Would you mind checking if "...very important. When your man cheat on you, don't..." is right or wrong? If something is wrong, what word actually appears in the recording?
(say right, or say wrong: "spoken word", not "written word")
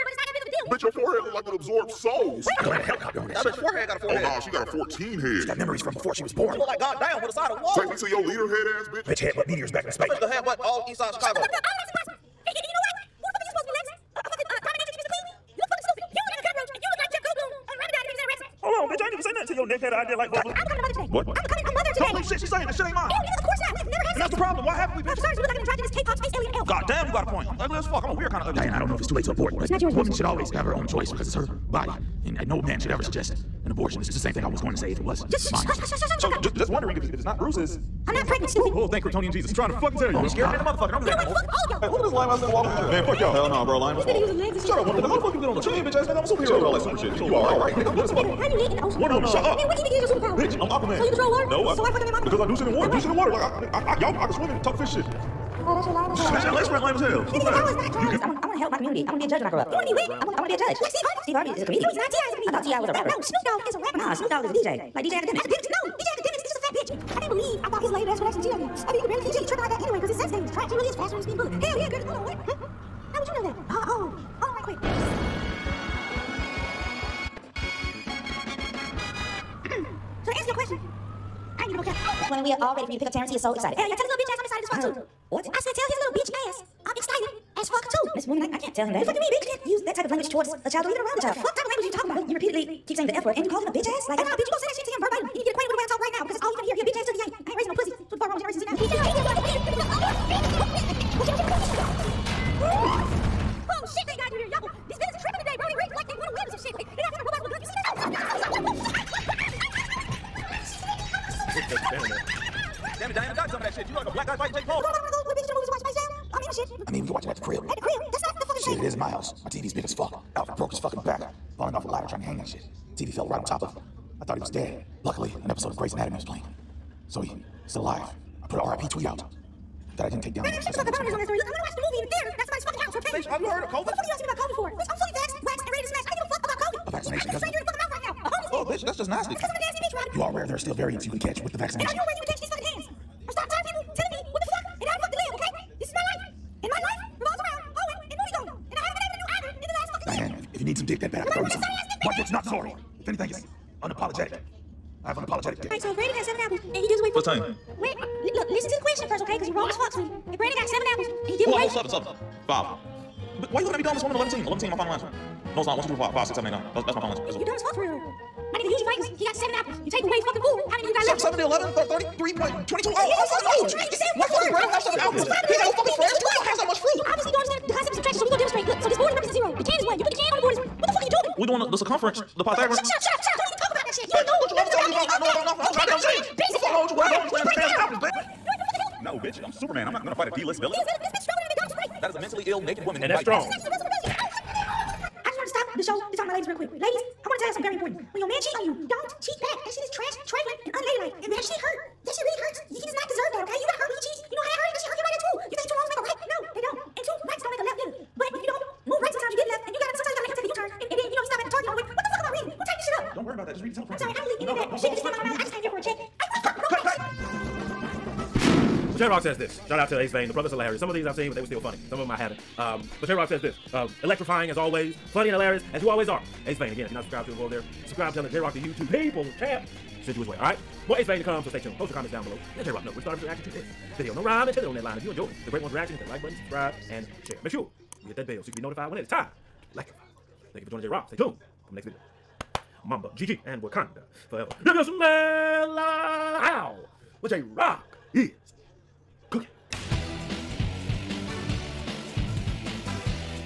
right.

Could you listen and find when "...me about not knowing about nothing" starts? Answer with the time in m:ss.
3:04.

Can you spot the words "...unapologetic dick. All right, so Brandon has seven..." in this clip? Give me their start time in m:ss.
2:35.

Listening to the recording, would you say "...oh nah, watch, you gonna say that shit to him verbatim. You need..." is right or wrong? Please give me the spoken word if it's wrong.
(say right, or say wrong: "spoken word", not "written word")
wrong: "bitch", not "watch".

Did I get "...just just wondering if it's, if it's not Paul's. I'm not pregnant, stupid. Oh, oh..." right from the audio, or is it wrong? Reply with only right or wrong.
wrong.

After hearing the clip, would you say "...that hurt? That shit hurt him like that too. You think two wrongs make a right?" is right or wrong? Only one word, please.
right.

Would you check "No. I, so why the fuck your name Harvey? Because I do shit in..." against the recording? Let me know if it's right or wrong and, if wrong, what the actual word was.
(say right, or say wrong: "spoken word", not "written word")
wrong: "Aquaman", not "Harvey".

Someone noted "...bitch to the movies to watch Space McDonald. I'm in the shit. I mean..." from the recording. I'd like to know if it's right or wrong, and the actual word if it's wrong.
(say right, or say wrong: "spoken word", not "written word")
wrong: "Jam", not "McDonald".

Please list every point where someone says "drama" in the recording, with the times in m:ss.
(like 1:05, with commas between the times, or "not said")
not said.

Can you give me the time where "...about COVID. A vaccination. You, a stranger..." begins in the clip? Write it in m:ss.
2:16.